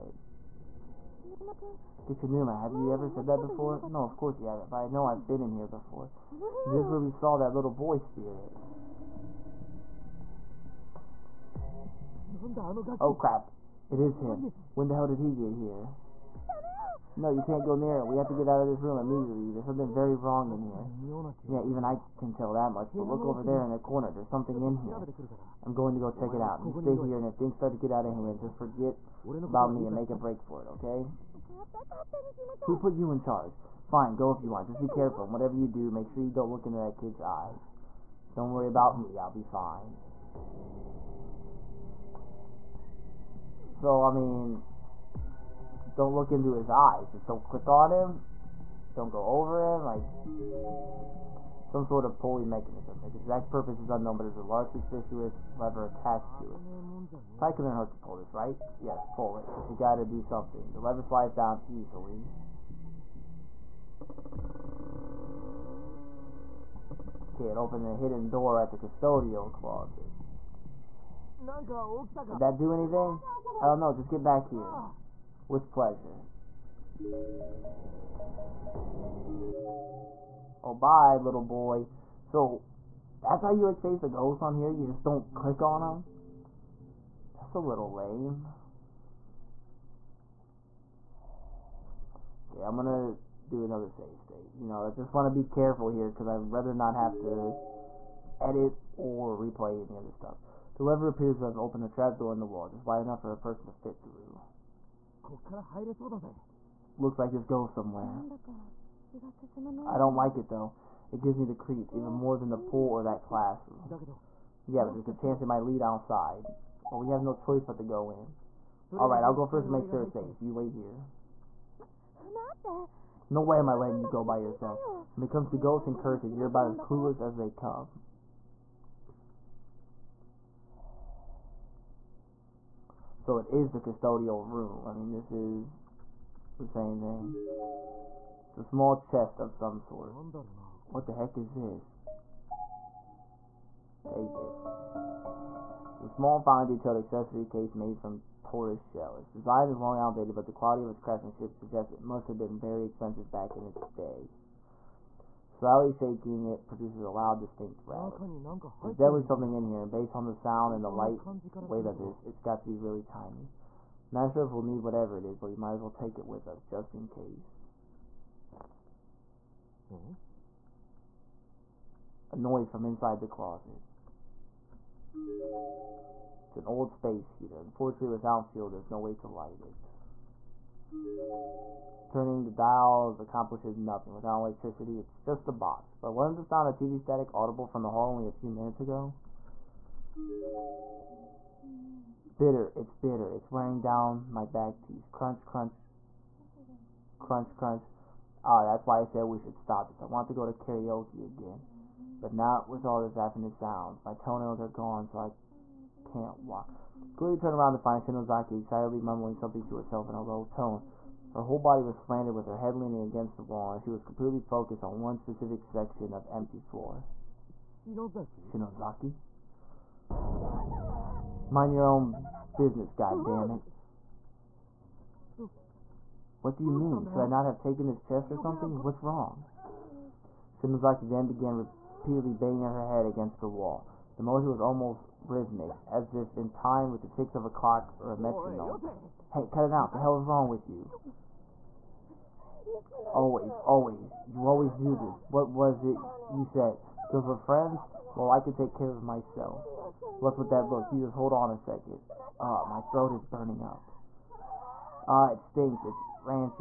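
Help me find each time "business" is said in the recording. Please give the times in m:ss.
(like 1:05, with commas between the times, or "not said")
3:42.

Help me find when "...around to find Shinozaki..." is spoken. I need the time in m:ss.
3:27.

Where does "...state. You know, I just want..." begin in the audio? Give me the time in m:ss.
1:34.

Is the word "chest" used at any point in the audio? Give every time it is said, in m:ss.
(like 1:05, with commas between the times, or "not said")
2:18, 3:47.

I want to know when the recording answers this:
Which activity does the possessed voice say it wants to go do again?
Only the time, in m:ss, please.
3:20.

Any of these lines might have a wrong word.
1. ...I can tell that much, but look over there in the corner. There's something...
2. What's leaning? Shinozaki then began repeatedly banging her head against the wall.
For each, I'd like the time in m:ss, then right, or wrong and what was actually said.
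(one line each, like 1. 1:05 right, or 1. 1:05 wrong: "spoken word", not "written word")
1. 0:21 right
2. 3:48 wrong: "wrong", not "leaning".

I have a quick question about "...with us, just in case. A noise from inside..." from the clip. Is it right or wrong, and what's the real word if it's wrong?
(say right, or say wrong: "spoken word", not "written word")
right.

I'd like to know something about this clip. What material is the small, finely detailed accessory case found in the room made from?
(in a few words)
tortoise shell.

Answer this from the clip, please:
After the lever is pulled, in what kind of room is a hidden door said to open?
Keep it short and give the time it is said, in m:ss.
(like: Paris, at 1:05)
custodial closet, at 1:08.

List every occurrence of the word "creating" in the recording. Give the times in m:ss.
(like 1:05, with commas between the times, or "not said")
not said.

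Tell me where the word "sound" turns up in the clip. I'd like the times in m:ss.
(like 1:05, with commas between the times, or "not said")
2:40, 3:06, 3:23.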